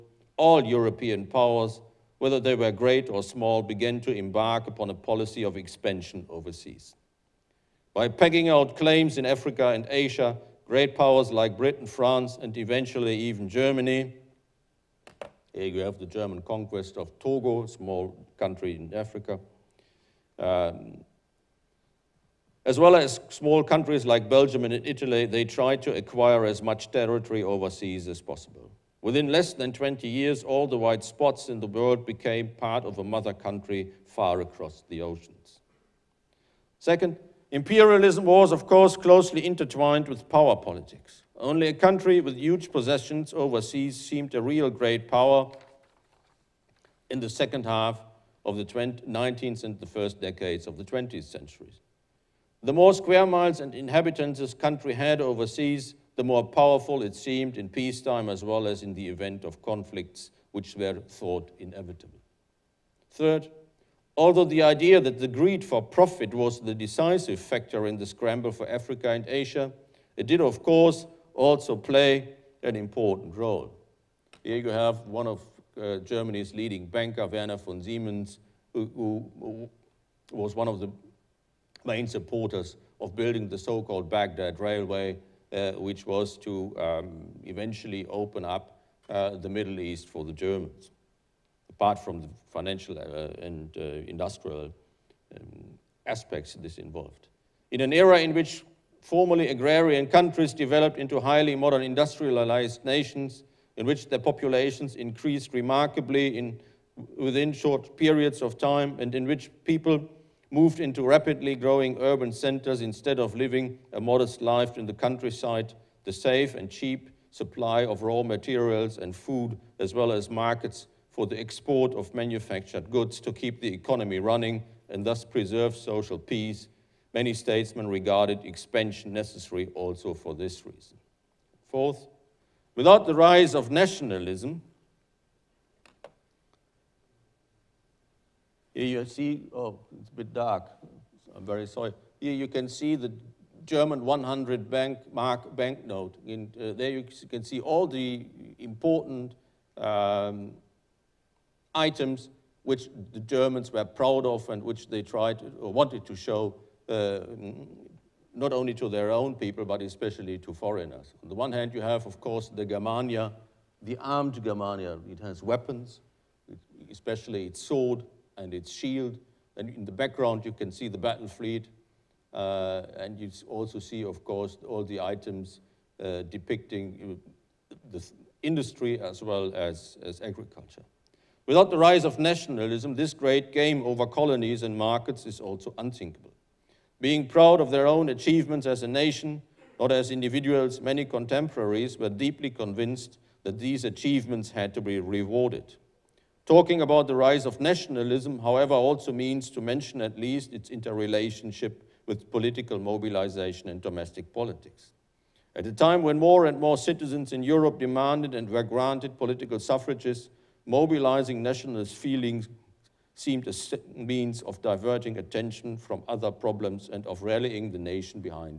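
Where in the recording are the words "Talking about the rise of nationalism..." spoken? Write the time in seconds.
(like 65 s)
196 s.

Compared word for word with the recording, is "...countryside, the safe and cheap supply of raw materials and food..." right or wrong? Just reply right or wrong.
right.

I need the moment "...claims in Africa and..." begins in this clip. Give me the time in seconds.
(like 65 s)
8 s.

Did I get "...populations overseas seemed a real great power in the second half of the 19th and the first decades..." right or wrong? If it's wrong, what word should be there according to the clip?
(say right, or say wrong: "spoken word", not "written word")
wrong: "possessions", not "populations".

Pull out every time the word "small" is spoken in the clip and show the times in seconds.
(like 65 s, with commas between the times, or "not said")
3 s, 17 s, 23 s.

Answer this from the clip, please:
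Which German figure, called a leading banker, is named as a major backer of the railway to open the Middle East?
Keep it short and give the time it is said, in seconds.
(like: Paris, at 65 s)
Werner von Siemens, at 77 s.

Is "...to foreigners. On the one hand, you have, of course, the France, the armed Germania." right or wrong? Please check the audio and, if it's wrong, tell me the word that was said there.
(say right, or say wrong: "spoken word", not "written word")
wrong: "Germania", not "France".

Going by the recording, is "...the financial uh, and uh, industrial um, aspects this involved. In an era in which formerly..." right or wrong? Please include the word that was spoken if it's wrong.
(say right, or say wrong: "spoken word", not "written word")
right.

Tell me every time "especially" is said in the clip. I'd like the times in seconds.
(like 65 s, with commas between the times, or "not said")
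159 s, 166 s.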